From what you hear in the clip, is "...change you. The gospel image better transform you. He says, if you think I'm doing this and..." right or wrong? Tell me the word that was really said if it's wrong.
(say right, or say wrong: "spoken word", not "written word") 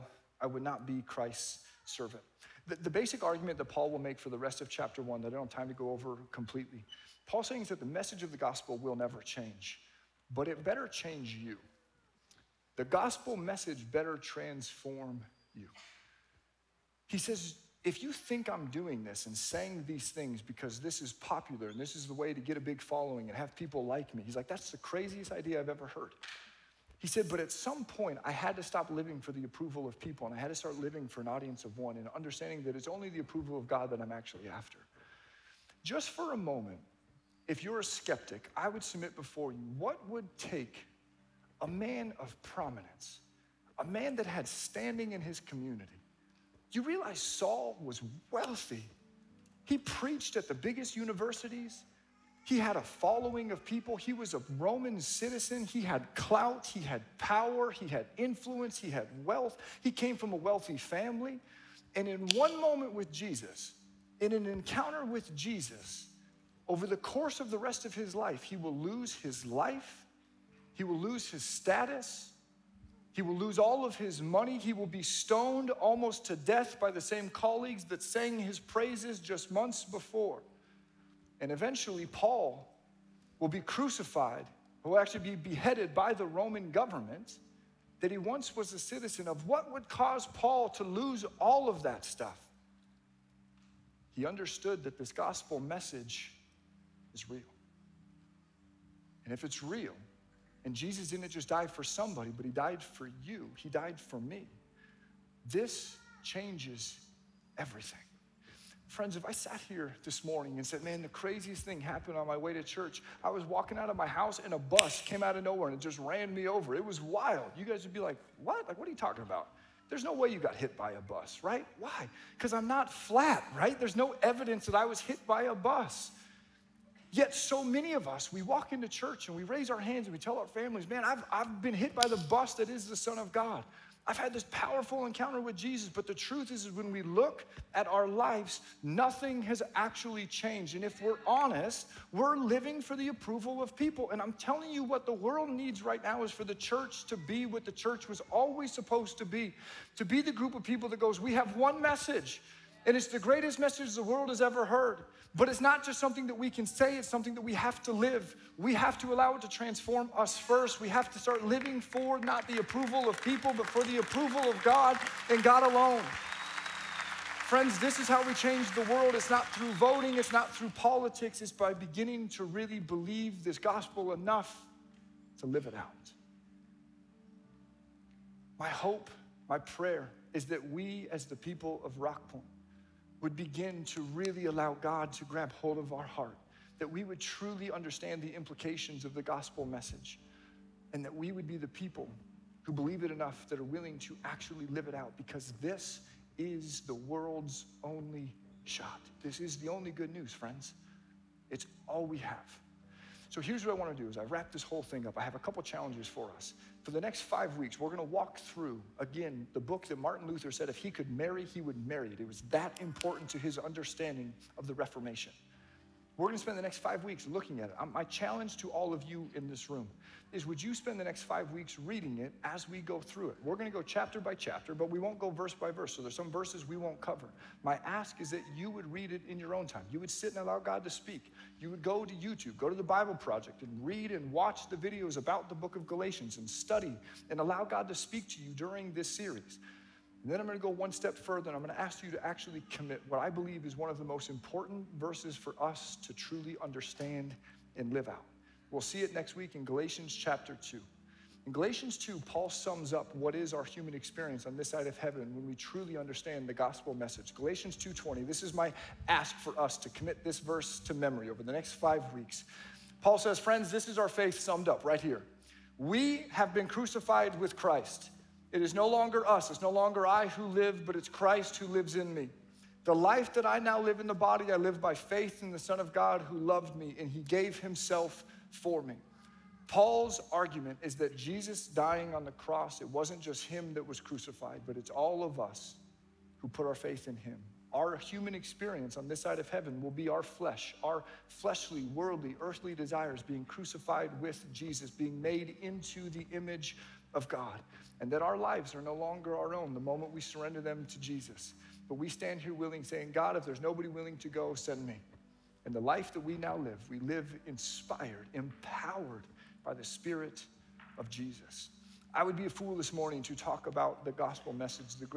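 wrong: "message", not "image".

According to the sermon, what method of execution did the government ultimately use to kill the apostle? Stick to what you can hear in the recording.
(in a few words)
Beheaded.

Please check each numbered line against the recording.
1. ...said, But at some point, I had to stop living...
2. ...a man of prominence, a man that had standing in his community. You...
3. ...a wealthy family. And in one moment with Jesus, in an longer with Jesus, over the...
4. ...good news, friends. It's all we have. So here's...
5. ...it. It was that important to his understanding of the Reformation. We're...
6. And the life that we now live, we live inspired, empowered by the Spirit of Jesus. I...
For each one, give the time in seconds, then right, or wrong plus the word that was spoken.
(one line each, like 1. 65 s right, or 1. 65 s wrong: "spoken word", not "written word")
1. 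27 s right
2. 41 s right
3. 60 s wrong: "encounter", not "longer"
4. 199 s right
5. 212 s right
6. 305 s right.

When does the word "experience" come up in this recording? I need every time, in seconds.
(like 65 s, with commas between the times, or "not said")
253 s, 288 s.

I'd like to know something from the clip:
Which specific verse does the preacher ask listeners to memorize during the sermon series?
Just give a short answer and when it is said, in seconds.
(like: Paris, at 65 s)
Galatians 2:20, at 257 s.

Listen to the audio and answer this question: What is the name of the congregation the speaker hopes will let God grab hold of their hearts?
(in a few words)
Rock Point.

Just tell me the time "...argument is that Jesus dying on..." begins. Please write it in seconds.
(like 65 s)
280 s.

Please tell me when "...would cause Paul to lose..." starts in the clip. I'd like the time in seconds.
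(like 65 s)
89 s.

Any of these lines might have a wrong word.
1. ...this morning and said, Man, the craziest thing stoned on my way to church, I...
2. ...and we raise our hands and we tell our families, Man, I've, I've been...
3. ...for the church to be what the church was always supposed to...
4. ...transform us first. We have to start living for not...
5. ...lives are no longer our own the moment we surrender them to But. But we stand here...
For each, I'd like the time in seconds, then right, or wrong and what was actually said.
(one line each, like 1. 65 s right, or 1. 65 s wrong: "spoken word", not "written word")
1. 110 s wrong: "happened", not "stoned"
2. 129 s right
3. 146 s right
4. 159 s right
5. 298 s wrong: "Jesus", not "But".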